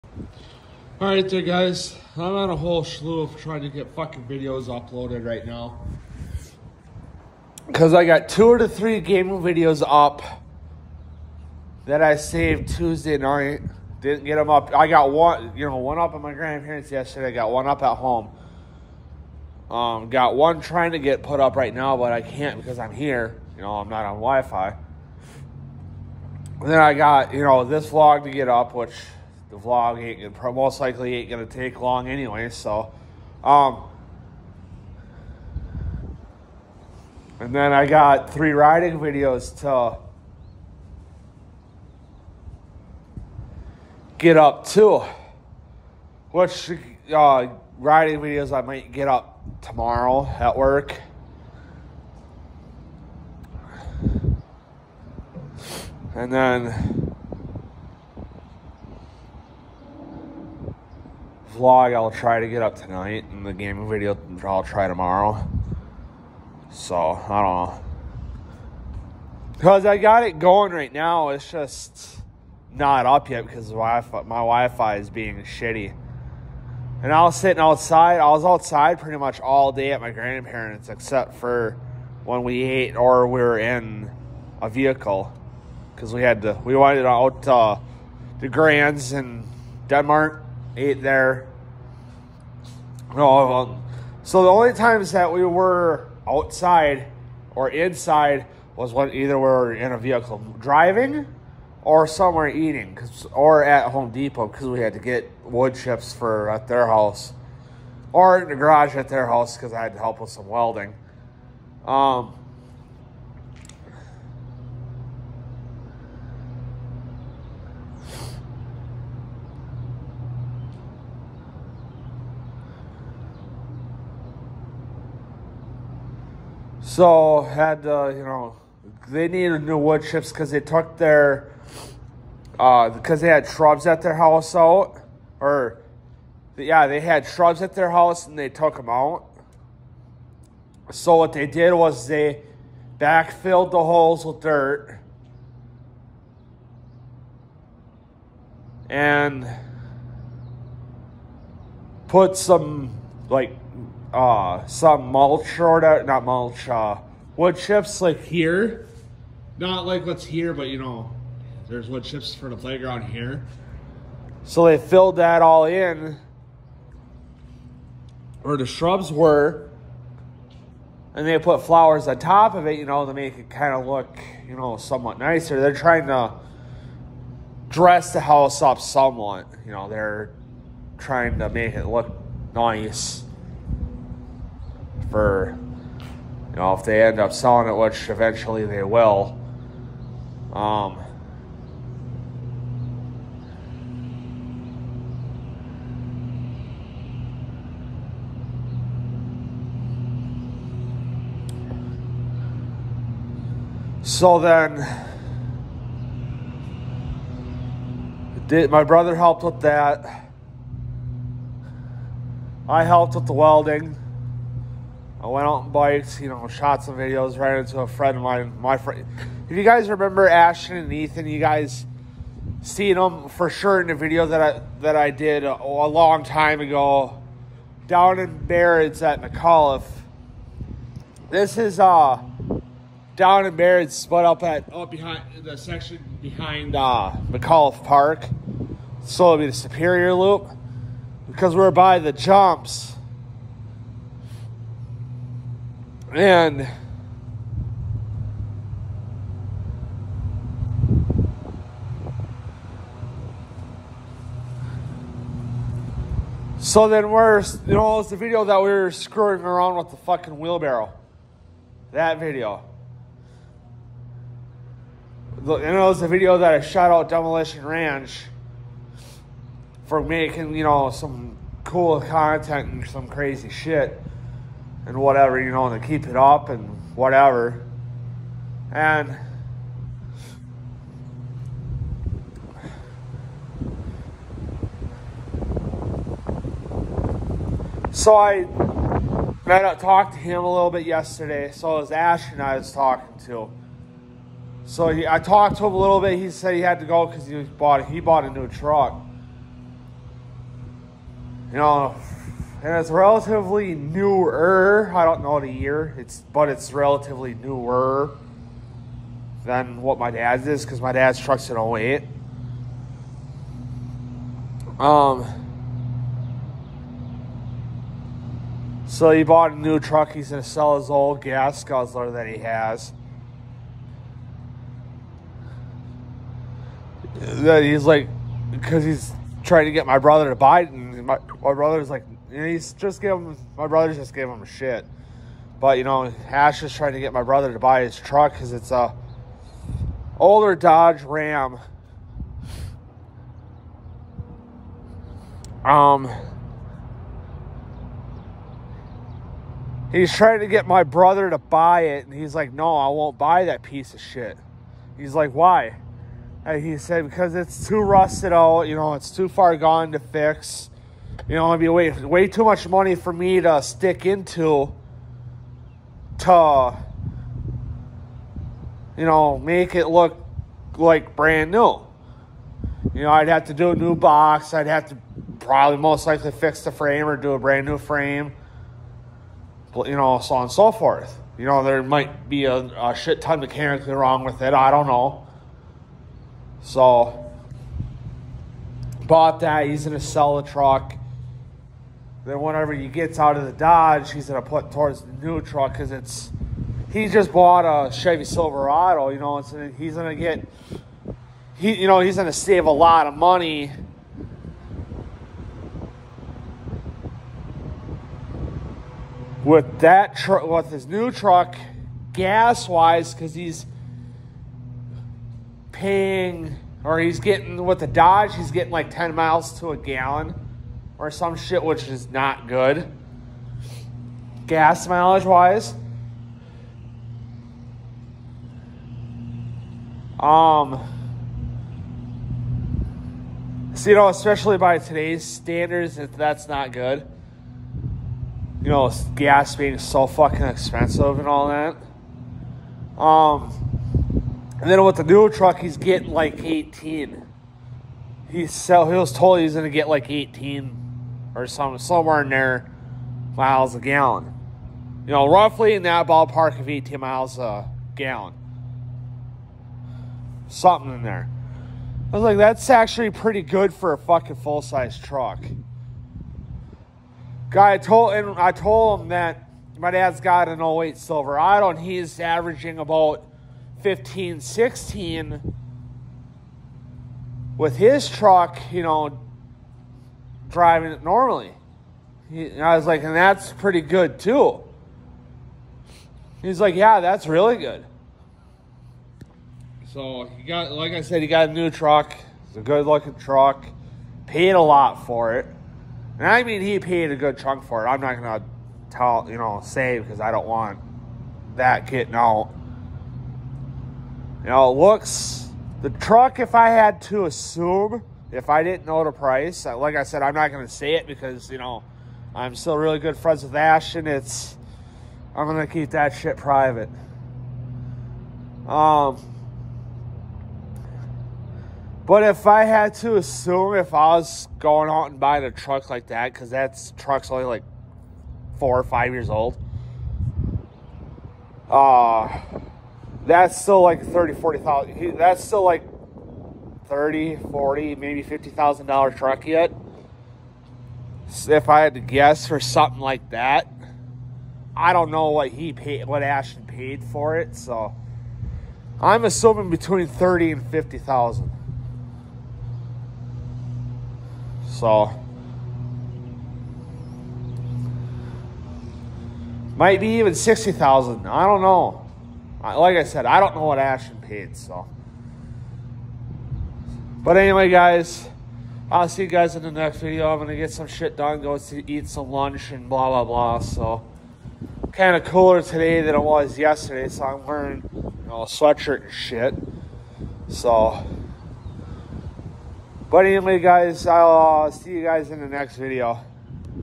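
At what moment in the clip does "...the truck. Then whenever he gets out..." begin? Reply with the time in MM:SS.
06:30.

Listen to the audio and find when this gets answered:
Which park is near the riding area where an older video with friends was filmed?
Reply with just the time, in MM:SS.
03:57.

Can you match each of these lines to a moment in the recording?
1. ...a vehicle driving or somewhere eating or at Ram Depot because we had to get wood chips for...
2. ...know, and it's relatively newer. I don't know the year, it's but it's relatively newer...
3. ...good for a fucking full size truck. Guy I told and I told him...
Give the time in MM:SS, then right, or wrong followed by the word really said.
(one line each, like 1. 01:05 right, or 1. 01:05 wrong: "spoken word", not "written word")
1. 01:39 wrong: "Home", not "Ram"
2. 05:01 right
3. 07:43 right.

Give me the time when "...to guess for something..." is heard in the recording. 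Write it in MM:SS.
09:01.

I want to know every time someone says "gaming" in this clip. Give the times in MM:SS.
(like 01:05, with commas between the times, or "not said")
00:08, 01:03.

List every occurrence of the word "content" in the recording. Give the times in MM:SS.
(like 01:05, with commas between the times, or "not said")
04:31.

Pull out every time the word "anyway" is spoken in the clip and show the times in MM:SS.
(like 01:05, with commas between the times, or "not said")
00:32, 09:27, 09:43.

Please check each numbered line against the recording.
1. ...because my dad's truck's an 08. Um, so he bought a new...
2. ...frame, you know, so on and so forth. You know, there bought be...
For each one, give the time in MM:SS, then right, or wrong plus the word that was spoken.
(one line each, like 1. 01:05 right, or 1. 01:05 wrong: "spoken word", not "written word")
1. 05:10 right
2. 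06:17 wrong: "might", not "bought".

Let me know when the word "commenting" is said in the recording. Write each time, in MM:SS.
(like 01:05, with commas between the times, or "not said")
not said.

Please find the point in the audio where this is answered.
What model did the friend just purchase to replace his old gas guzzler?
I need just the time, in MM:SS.
06:37.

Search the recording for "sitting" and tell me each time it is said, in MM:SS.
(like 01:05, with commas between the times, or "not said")
01:17.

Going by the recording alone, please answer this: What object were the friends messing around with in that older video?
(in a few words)
wheelbarrow.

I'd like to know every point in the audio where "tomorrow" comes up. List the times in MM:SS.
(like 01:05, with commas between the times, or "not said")
00:49, 01:04.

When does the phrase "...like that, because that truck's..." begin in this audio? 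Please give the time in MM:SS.
08:45.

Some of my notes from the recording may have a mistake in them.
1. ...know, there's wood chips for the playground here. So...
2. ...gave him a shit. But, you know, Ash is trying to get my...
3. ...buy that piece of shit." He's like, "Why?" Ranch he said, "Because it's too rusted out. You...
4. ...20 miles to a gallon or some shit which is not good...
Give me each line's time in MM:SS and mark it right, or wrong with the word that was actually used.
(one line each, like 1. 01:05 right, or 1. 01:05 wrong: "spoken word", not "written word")
1. 02:40 right
2. 05:34 right
3. 05:53 wrong: "And", not "Ranch"
4. 06:58 wrong: "10", not "20".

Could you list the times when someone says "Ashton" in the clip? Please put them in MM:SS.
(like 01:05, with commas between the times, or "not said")
03:40, 08:33, 09:06, 09:23.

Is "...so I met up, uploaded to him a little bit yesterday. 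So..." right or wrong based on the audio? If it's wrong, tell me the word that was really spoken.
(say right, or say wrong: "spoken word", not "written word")
wrong: "talked", not "uploaded".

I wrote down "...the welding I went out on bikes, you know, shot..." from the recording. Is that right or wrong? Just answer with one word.
right.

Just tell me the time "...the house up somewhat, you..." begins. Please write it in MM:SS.
02:58.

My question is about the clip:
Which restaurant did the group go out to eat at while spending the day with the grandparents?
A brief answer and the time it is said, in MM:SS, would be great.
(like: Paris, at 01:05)
the Grands in Denmark, at 01:28.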